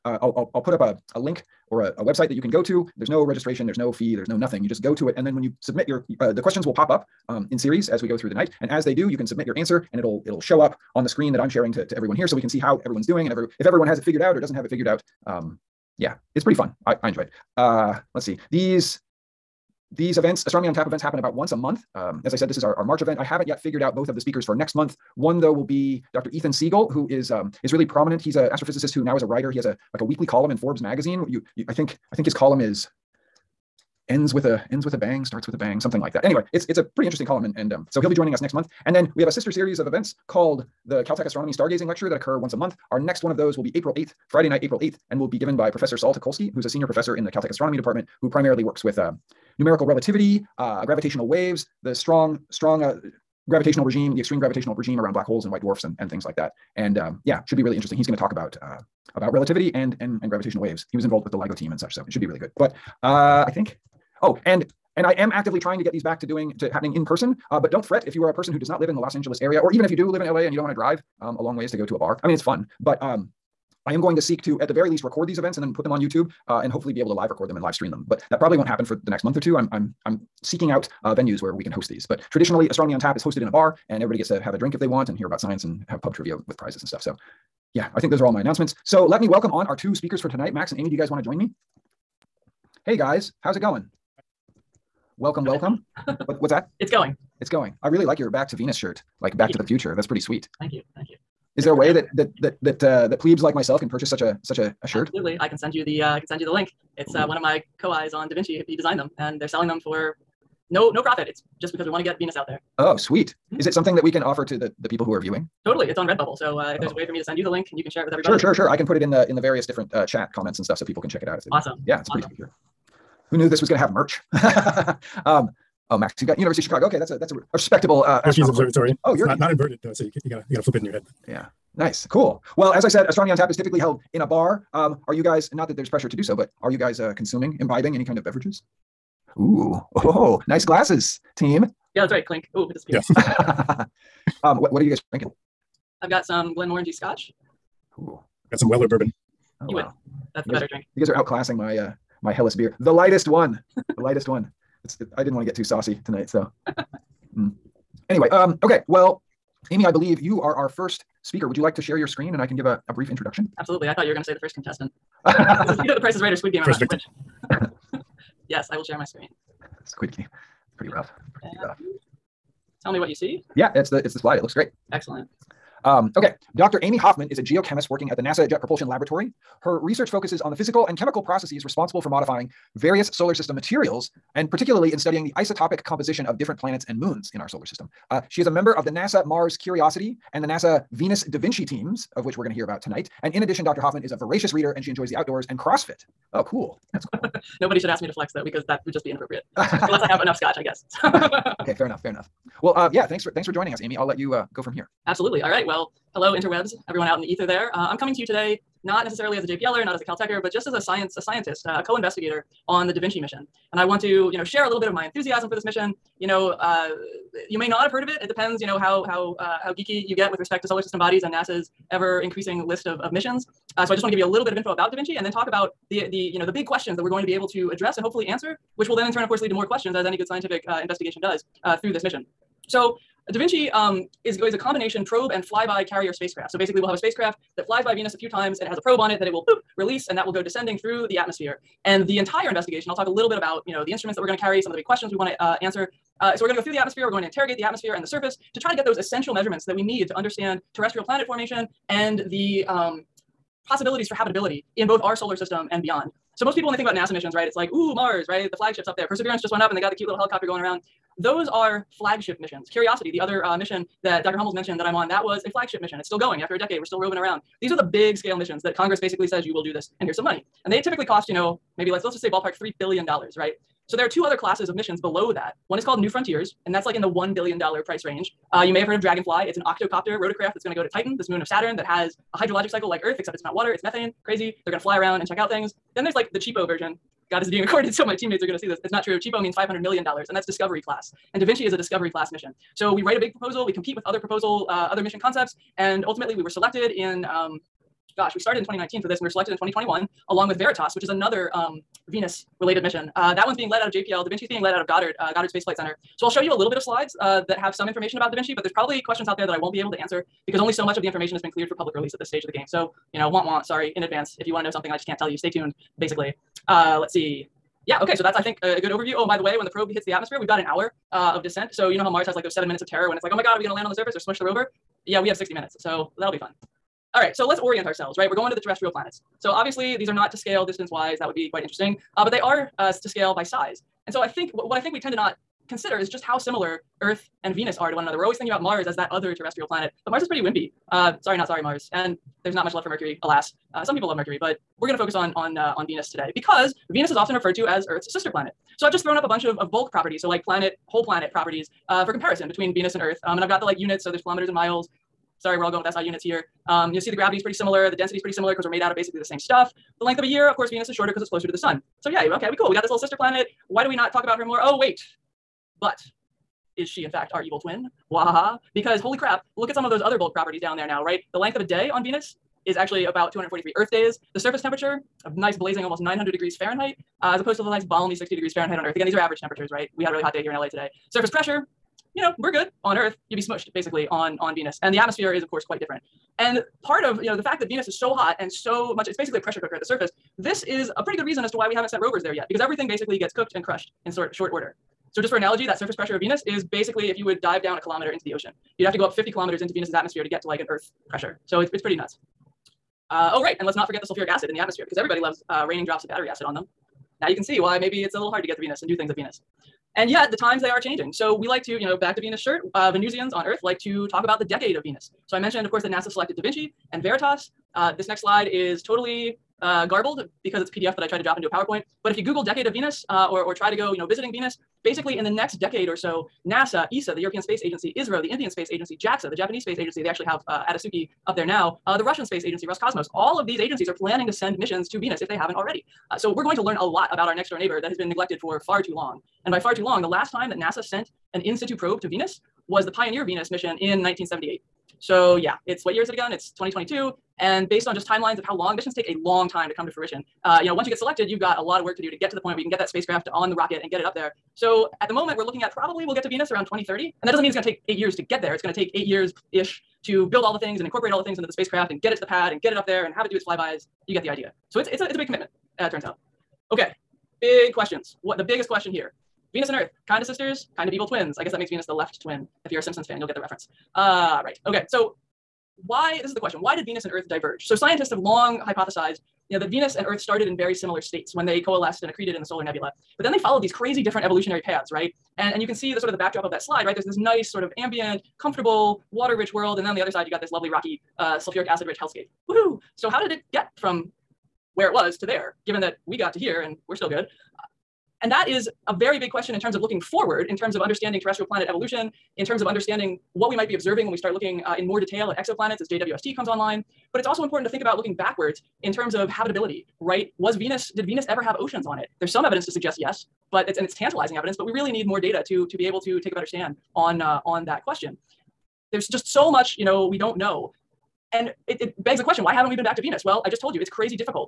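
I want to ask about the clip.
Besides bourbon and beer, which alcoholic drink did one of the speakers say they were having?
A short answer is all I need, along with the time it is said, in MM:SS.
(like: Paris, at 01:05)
Glenmorangie Scotch, at 02:26.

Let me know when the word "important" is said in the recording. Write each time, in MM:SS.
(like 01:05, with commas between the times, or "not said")
08:27.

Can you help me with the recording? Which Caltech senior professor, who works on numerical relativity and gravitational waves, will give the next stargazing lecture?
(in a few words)
Saul Teukolsky.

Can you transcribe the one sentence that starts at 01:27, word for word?
So, yeah, I think those are all my announcements.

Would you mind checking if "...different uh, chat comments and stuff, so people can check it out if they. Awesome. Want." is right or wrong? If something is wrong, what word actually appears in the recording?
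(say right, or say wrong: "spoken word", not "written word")
right.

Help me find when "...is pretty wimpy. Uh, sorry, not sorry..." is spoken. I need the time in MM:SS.
05:40.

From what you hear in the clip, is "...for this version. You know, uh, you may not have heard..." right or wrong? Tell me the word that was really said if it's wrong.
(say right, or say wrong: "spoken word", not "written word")
wrong: "mission", not "version".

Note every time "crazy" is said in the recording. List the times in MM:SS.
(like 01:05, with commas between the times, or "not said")
04:44, 08:03, 08:43.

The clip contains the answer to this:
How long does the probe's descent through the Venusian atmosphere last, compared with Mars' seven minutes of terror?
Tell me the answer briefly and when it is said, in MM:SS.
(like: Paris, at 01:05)
60 minutes, at 05:25.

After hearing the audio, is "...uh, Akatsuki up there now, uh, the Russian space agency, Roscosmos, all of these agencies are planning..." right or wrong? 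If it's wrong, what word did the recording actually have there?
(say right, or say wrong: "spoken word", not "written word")
right.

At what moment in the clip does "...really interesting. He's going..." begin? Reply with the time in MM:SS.
00:57.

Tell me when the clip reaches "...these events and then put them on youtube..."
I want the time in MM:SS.
01:15.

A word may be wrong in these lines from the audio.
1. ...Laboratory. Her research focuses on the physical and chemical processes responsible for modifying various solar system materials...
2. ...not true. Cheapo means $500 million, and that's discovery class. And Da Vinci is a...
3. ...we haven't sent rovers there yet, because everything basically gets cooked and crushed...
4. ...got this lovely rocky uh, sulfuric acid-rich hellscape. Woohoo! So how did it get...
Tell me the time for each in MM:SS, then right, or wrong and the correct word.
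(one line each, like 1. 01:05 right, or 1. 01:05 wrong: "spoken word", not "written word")
1. 02:58 right
2. 04:48 right
3. 06:31 right
4. 08:10 right.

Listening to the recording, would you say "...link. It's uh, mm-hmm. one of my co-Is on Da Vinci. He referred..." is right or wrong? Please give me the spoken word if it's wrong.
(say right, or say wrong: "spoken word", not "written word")
wrong: "designed", not "referred".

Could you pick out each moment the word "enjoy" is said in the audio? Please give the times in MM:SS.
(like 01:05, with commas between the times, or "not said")
00:17, 03:14.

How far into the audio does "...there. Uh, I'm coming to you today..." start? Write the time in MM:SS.
03:27.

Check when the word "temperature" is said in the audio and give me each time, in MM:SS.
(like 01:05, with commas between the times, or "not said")
06:14, 06:19.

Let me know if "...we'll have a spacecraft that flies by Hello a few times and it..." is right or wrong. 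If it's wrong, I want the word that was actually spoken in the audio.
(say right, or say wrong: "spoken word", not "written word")
wrong: "Venus", not "Hello".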